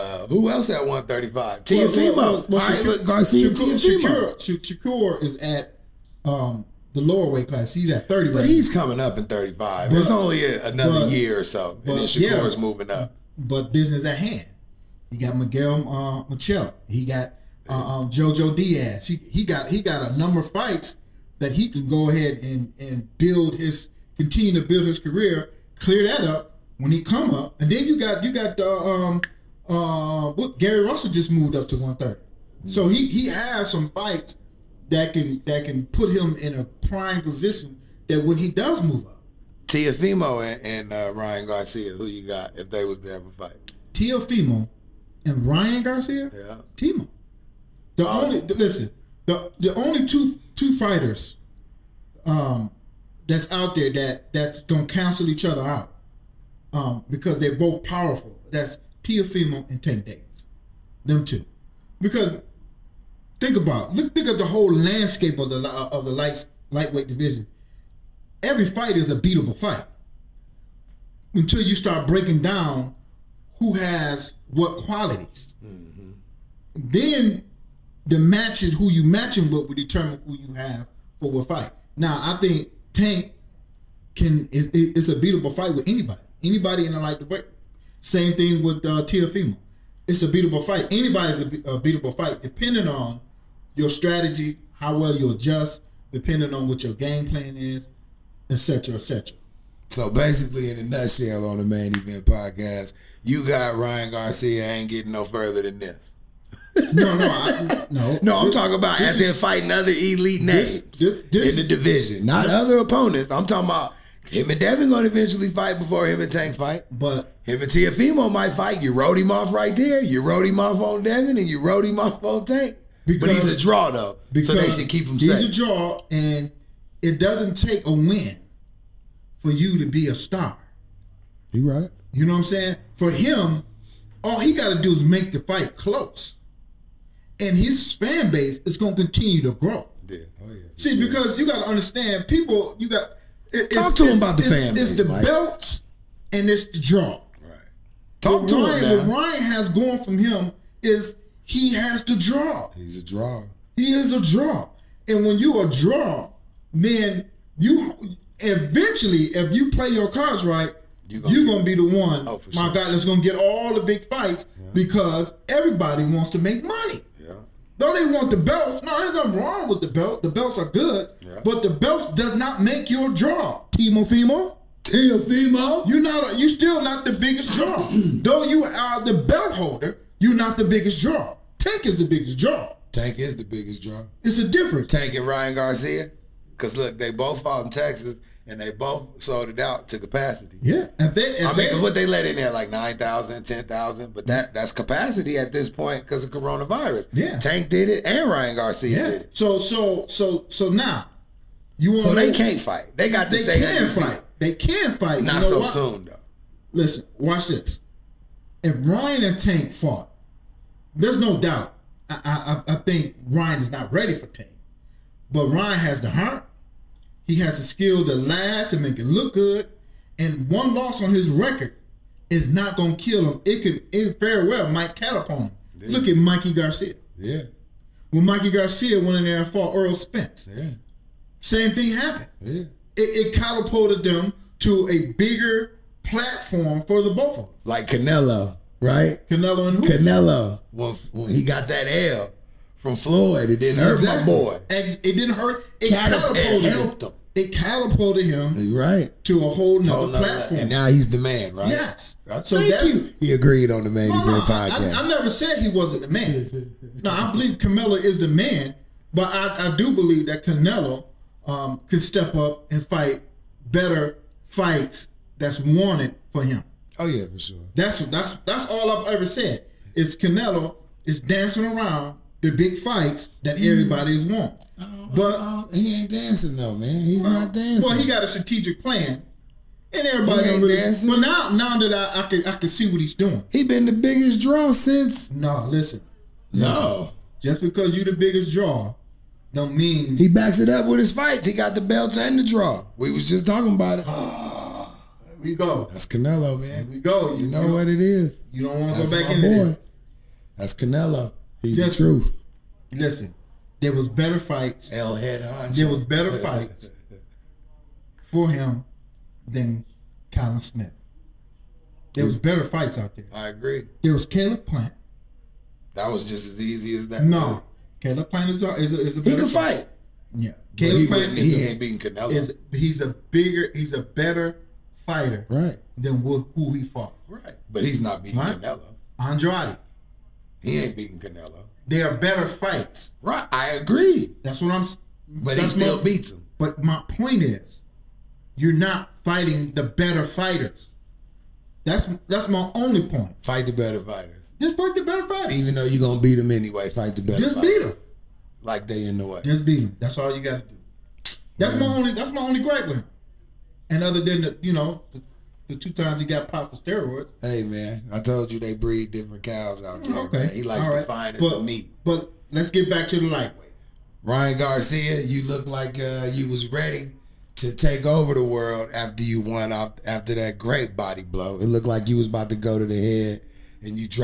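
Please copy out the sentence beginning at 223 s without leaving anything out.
It could, in farewell, might catapult him.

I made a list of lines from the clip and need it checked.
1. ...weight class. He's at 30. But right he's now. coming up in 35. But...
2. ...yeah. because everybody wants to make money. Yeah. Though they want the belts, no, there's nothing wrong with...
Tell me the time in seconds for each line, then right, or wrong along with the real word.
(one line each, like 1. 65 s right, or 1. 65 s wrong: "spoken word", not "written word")
1. 7 s right
2. 164 s right.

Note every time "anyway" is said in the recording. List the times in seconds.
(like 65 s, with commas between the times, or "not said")
346 s.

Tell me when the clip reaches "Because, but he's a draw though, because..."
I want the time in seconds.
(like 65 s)
123 s.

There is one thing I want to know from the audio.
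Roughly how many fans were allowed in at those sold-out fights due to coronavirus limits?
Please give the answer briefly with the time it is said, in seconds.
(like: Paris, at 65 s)
9,000 to 10,000, at 192 s.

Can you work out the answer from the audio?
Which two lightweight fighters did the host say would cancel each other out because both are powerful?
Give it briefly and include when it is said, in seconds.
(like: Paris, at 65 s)
Teofimo and Tank Davis, at 59 s.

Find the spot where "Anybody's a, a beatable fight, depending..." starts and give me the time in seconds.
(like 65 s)
90 s.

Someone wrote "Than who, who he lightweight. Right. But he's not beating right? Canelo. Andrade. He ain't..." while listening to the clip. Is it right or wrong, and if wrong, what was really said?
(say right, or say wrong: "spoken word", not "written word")
wrong: "fought", not "lightweight".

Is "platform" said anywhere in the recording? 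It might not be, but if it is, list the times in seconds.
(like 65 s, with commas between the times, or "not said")
236 s, 250 s.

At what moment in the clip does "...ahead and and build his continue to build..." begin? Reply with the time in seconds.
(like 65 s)
22 s.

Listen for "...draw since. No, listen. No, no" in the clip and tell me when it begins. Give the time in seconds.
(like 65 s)
284 s.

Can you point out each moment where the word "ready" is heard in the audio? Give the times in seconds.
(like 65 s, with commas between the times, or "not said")
213 s, 366 s.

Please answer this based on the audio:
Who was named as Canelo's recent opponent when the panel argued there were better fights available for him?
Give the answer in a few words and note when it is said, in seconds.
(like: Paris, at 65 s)
Callum Smith, at 310 s.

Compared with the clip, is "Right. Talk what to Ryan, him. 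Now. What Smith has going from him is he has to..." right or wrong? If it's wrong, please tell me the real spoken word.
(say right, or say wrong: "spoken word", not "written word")
wrong: "Ryan", not "Smith".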